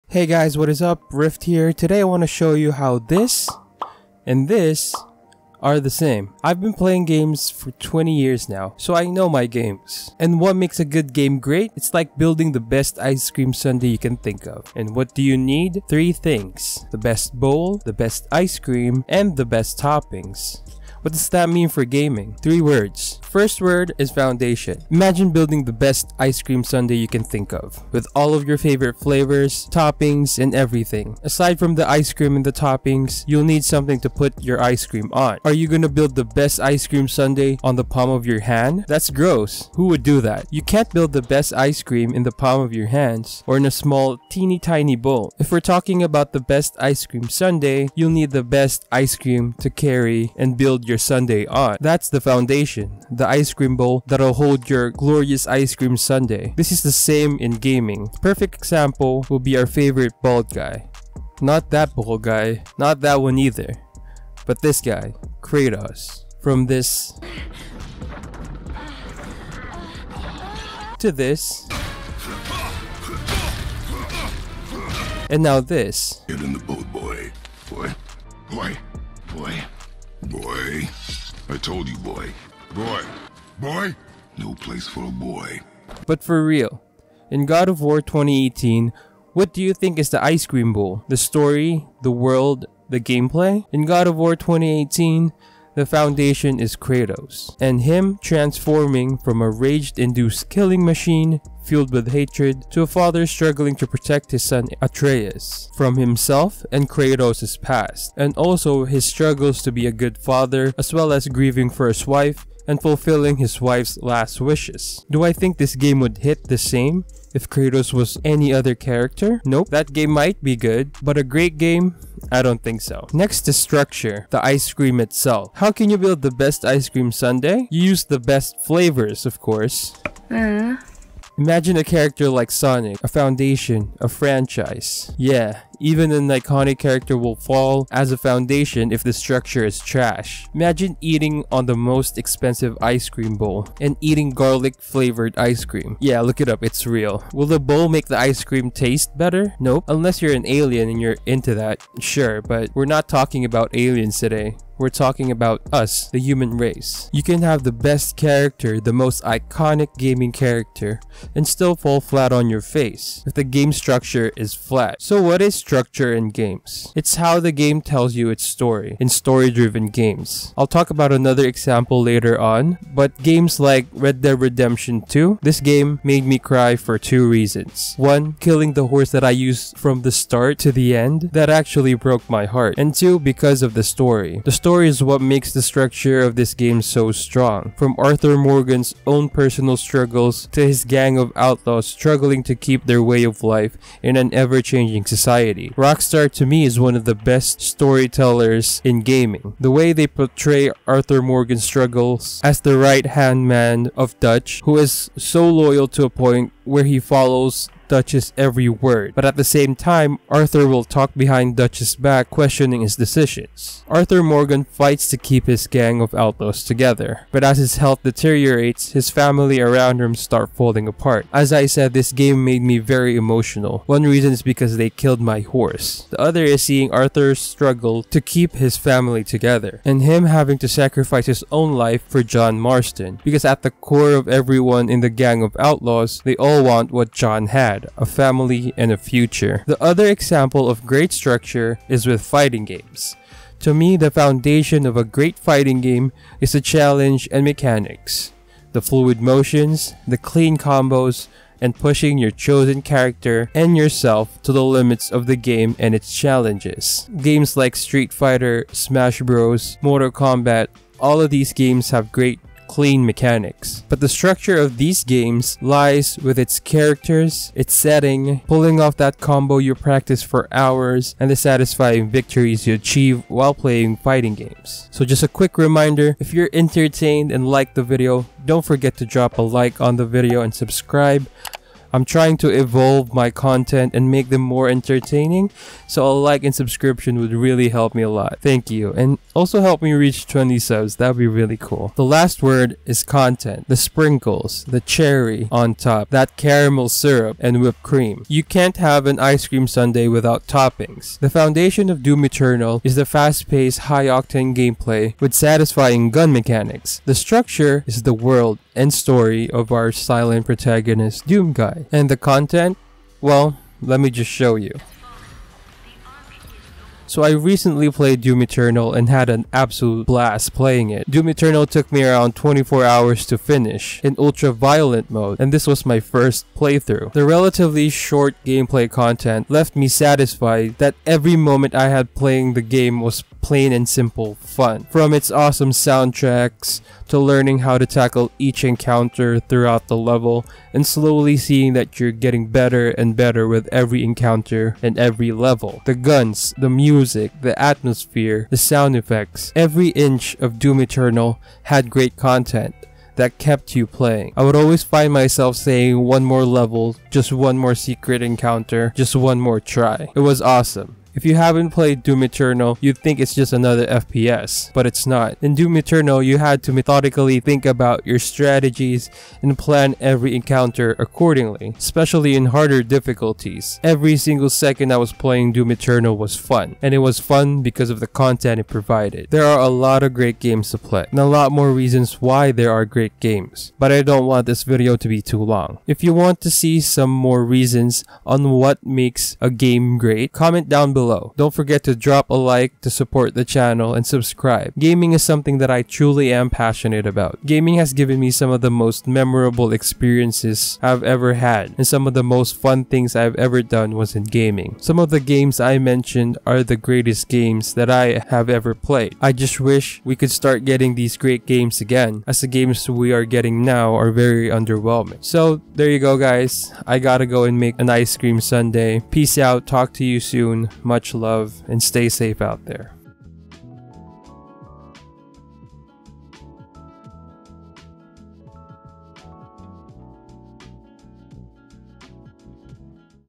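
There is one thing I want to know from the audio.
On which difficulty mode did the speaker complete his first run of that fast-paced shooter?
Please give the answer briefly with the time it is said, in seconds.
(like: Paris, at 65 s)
Ultra violent, at 324 s.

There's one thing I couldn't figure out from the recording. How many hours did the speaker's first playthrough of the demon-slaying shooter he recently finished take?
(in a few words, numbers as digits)
24.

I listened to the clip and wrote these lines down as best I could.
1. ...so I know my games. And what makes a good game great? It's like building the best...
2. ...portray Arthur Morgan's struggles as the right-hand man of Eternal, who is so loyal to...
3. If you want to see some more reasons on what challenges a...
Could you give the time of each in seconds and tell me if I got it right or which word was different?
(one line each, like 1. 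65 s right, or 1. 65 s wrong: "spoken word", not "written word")
1. 8 s right
2. 200 s wrong: "Dutch", not "Eternal"
3. 385 s wrong: "makes", not "challenges".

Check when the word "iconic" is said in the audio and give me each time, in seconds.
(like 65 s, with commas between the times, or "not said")
136 s, 159 s.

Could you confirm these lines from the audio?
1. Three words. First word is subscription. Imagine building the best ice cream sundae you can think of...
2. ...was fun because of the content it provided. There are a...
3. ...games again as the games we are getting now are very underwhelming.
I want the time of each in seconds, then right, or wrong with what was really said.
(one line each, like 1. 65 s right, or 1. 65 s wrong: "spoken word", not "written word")
1. 22 s wrong: "foundation", not "subscription"
2. 376 s right
3. 411 s right.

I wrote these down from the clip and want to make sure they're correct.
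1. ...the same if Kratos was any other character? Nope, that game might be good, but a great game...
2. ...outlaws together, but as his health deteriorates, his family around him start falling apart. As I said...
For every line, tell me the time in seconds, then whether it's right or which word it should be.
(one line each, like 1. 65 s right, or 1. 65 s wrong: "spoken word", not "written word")
1. 116 s right
2. 216 s right.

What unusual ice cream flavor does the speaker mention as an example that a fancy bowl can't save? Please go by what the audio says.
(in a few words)
Garlic.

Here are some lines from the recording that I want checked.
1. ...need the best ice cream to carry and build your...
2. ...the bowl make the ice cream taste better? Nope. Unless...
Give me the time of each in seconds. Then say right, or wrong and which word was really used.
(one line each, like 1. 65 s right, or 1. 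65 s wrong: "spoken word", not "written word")
1. 48 s right
2. 147 s right.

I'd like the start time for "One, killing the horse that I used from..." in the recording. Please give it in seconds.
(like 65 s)
177 s.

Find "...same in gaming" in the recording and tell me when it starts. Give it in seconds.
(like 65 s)
56 s.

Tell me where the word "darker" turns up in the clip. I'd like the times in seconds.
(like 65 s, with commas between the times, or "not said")
not said.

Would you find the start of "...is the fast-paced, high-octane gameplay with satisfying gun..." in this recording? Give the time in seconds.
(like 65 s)
302 s.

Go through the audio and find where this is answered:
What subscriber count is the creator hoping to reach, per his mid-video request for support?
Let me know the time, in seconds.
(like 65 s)
290 s.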